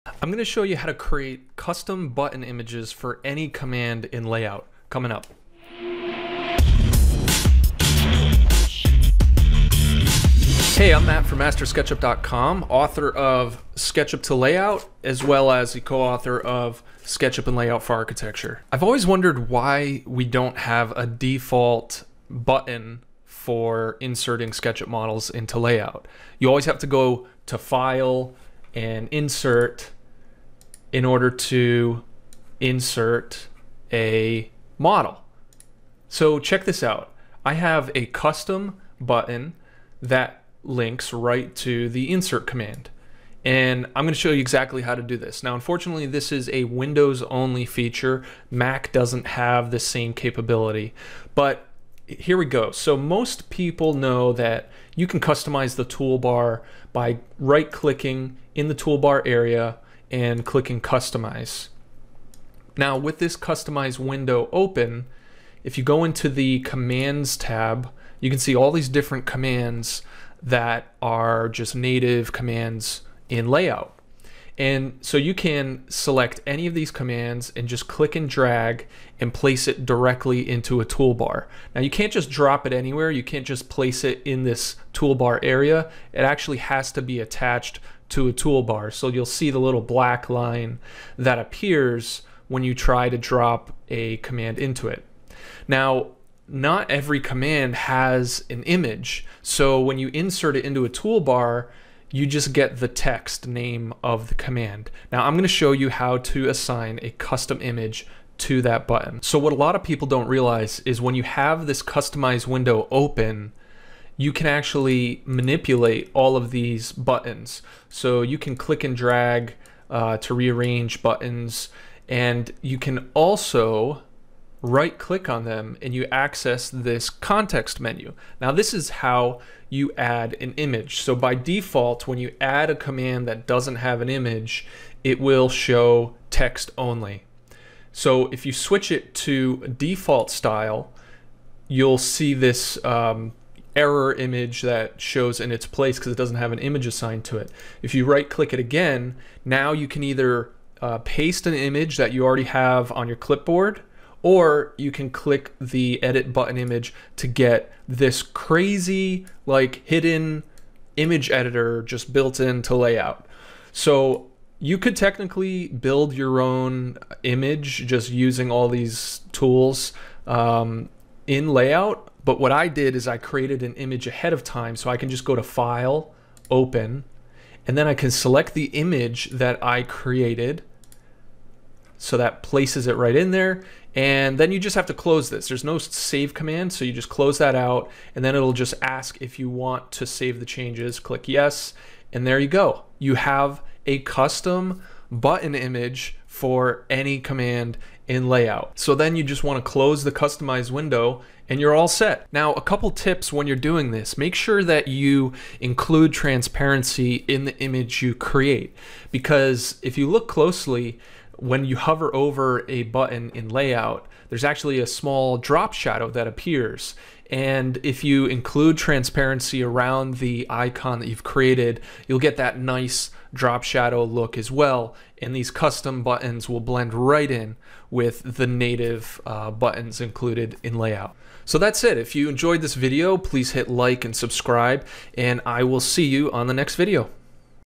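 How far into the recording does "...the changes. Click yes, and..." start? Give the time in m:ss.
3:10.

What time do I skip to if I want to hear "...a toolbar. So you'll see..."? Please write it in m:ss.
1:28.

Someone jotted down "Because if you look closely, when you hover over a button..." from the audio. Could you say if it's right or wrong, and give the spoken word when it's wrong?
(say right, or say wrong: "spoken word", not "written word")
right.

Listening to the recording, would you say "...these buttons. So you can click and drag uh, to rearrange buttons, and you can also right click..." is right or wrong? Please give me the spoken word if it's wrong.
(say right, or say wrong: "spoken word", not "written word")
right.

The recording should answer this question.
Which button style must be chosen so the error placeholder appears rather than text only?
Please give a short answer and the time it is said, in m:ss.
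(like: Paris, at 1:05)
default style, at 2:19.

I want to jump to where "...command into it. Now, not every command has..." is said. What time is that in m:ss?
1:34.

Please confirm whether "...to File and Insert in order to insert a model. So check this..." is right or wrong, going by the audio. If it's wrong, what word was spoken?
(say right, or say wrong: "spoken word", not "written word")
right.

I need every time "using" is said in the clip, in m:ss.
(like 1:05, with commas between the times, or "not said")
2:48.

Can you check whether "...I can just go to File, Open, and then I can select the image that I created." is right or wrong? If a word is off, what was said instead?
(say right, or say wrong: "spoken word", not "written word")
right.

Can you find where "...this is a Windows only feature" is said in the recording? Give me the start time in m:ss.
0:46.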